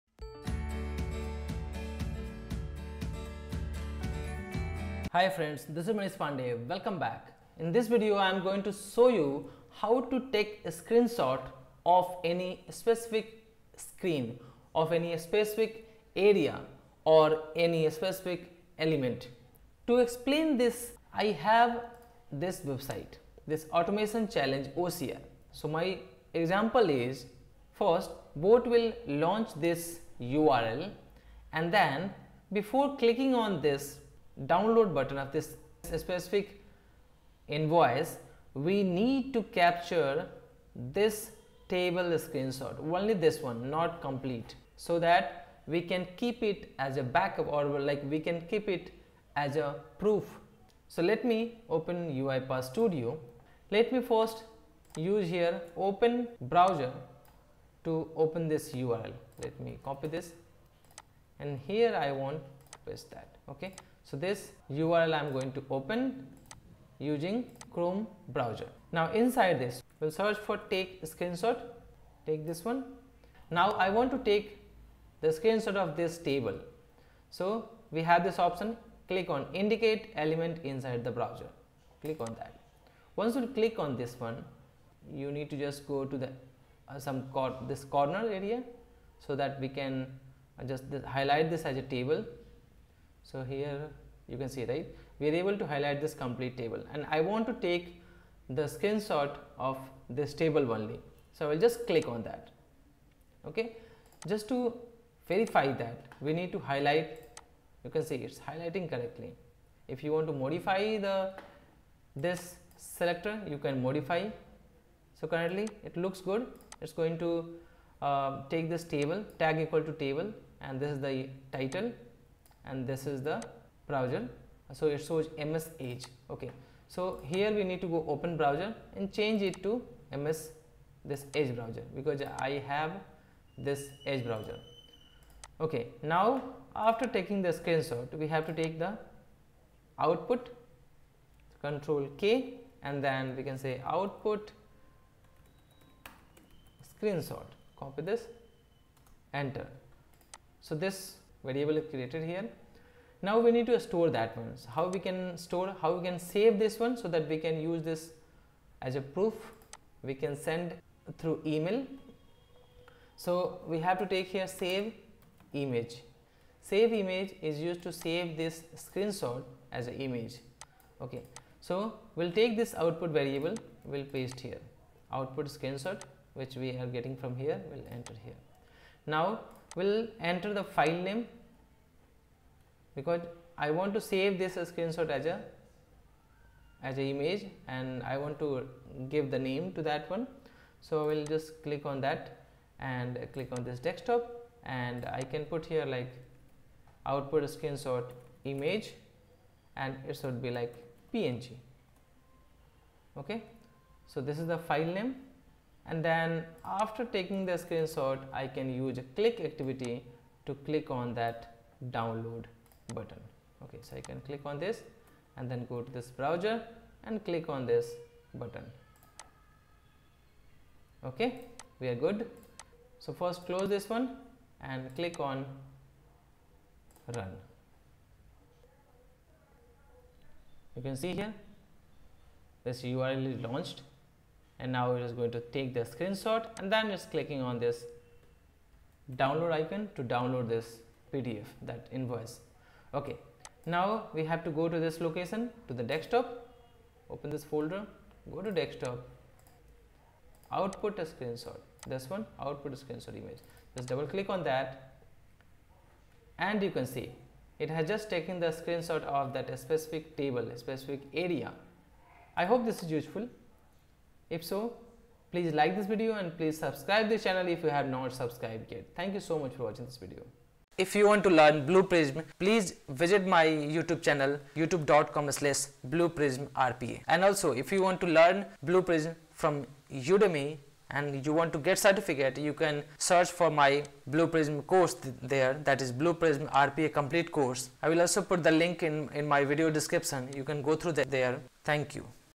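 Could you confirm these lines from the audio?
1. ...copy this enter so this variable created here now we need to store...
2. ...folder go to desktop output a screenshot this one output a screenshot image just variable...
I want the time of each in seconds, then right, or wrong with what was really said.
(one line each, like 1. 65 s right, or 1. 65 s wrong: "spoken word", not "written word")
1. 147 s right
2. 247 s wrong: "double", not "variable".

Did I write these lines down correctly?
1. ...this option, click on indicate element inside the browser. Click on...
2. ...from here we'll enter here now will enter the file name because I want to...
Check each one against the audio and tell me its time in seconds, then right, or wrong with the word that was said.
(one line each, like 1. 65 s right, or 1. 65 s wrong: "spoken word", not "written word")
1. 78 s right
2. 177 s right.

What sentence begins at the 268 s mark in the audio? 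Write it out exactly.
Thank you so much for watching this video.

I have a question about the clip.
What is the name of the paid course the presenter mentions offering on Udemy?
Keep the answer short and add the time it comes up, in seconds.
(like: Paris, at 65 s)
Blue Prism RPA complete course, at 286 s.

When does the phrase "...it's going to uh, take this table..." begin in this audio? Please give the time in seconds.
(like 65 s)
116 s.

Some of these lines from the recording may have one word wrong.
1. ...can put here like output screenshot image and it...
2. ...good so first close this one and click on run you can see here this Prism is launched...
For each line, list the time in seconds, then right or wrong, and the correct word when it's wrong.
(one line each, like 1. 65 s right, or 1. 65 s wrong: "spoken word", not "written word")
1. 195 s right
2. 221 s wrong: "URL", not "Prism".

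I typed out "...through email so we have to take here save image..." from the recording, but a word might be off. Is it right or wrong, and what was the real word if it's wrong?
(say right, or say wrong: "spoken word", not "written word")
right.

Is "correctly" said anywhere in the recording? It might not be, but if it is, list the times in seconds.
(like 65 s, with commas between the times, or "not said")
108 s.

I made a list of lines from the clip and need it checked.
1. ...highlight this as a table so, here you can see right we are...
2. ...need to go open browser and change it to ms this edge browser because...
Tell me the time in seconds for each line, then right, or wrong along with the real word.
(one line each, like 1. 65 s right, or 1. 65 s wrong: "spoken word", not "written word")
1. 91 s right
2. 127 s right.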